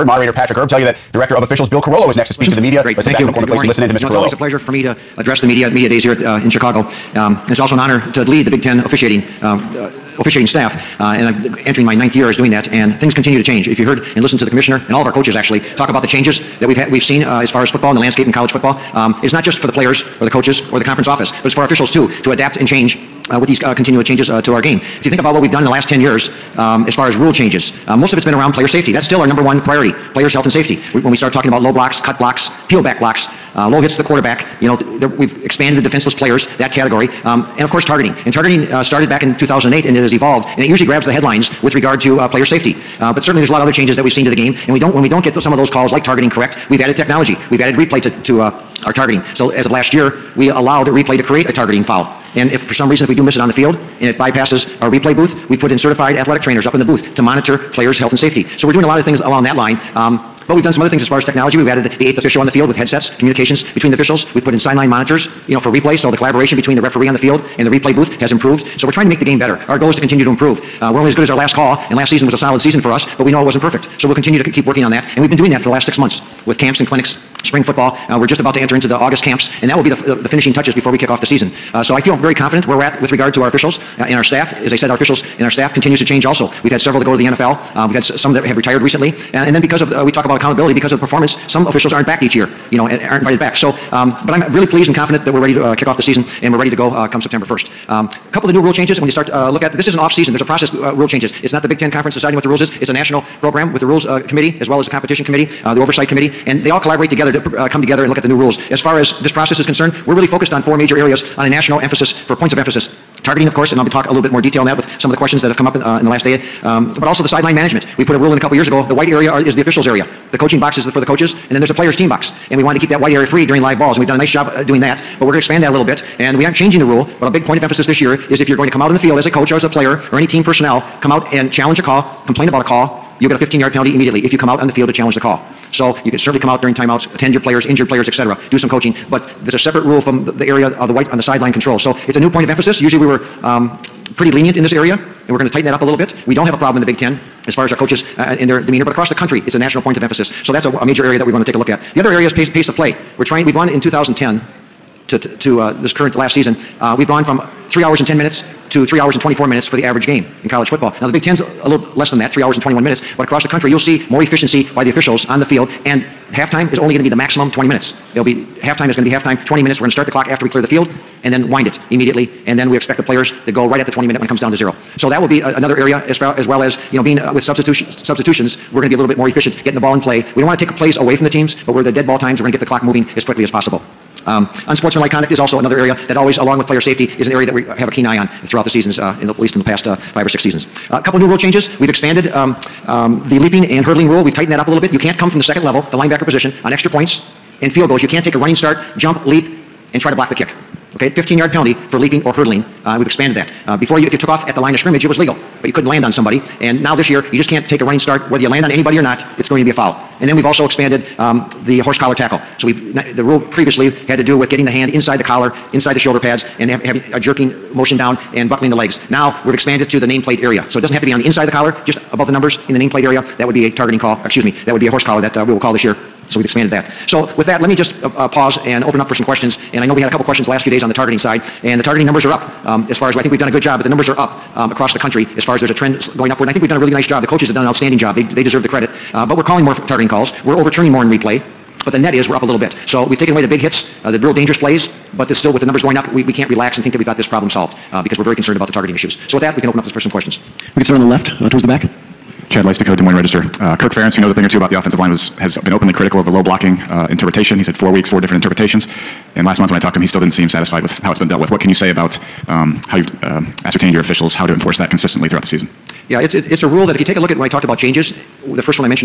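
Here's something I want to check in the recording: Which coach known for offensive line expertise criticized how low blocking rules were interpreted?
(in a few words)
Kirk Ferentz.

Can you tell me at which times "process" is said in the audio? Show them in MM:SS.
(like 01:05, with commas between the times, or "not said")
01:40, 01:49.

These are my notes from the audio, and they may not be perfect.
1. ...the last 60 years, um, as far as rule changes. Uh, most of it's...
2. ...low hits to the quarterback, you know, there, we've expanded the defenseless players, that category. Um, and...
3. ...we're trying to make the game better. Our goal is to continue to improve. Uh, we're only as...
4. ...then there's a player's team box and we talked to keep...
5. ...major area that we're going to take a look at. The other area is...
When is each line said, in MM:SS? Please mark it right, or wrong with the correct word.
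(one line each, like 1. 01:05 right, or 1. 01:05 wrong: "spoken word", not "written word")
1. 00:25 wrong: "10", not "60"
2. 00:33 right
3. 01:08 right
4. 02:01 wrong: "wanted", not "talked"
5. 02:30 right.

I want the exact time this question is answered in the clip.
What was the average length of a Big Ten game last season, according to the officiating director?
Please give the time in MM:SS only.
02:42.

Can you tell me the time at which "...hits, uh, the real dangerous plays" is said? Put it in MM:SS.
04:03.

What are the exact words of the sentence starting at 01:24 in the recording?
As I said, our officials and our staff continues to change also.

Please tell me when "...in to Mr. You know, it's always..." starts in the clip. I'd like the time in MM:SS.
00:03.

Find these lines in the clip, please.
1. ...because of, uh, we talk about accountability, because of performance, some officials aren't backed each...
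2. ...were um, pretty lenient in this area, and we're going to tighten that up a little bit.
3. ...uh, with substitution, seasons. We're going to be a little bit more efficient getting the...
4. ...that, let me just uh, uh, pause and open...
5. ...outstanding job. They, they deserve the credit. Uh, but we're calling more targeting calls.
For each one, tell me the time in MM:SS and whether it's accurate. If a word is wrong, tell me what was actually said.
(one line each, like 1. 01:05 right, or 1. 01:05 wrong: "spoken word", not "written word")
1. 01:29 right
2. 02:23 right
3. 02:57 wrong: "substitutions", not "seasons"
4. 03:47 right
5. 03:57 right.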